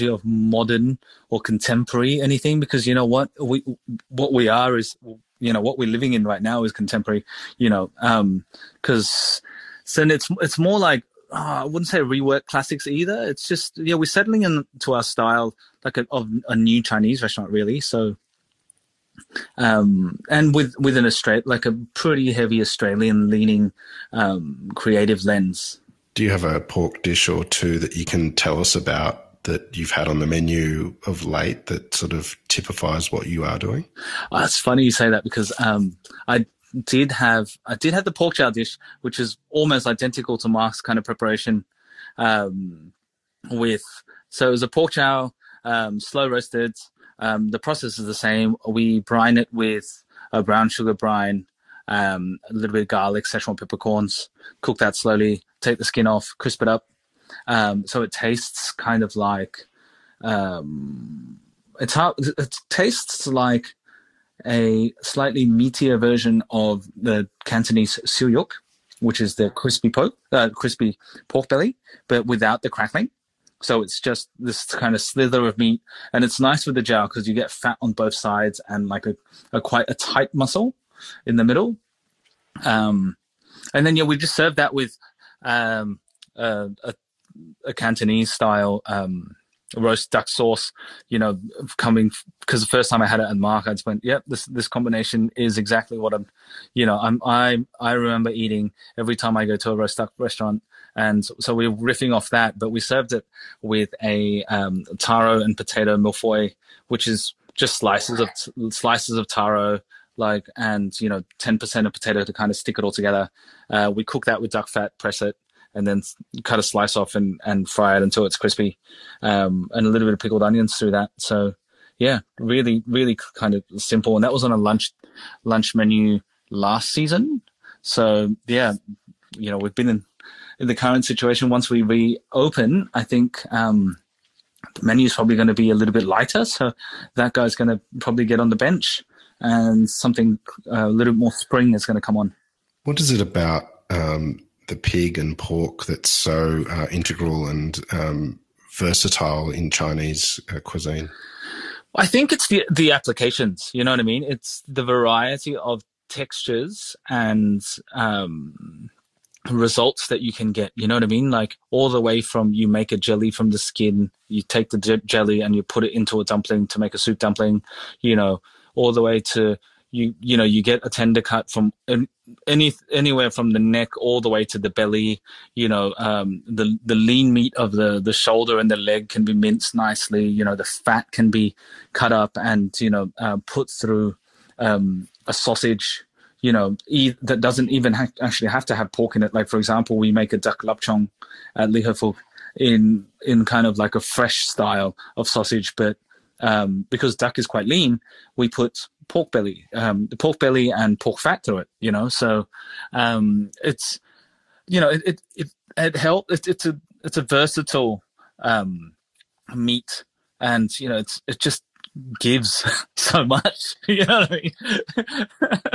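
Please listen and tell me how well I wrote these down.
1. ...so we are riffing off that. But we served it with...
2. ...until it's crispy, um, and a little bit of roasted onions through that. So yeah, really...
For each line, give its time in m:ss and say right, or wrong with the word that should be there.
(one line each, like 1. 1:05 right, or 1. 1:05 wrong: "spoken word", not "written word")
1. 1:41 right
2. 1:58 wrong: "pickled", not "roasted".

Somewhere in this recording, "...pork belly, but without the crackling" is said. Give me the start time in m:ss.
1:11.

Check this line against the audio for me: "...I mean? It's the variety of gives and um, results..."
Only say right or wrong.
wrong.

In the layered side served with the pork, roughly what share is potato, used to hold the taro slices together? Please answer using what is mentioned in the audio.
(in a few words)
10%.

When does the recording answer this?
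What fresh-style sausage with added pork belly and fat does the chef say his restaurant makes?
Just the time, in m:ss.
3:10.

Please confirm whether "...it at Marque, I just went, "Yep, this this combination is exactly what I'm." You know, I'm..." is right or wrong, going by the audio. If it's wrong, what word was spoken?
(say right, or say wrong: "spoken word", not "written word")
right.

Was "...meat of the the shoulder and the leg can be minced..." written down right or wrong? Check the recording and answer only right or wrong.
right.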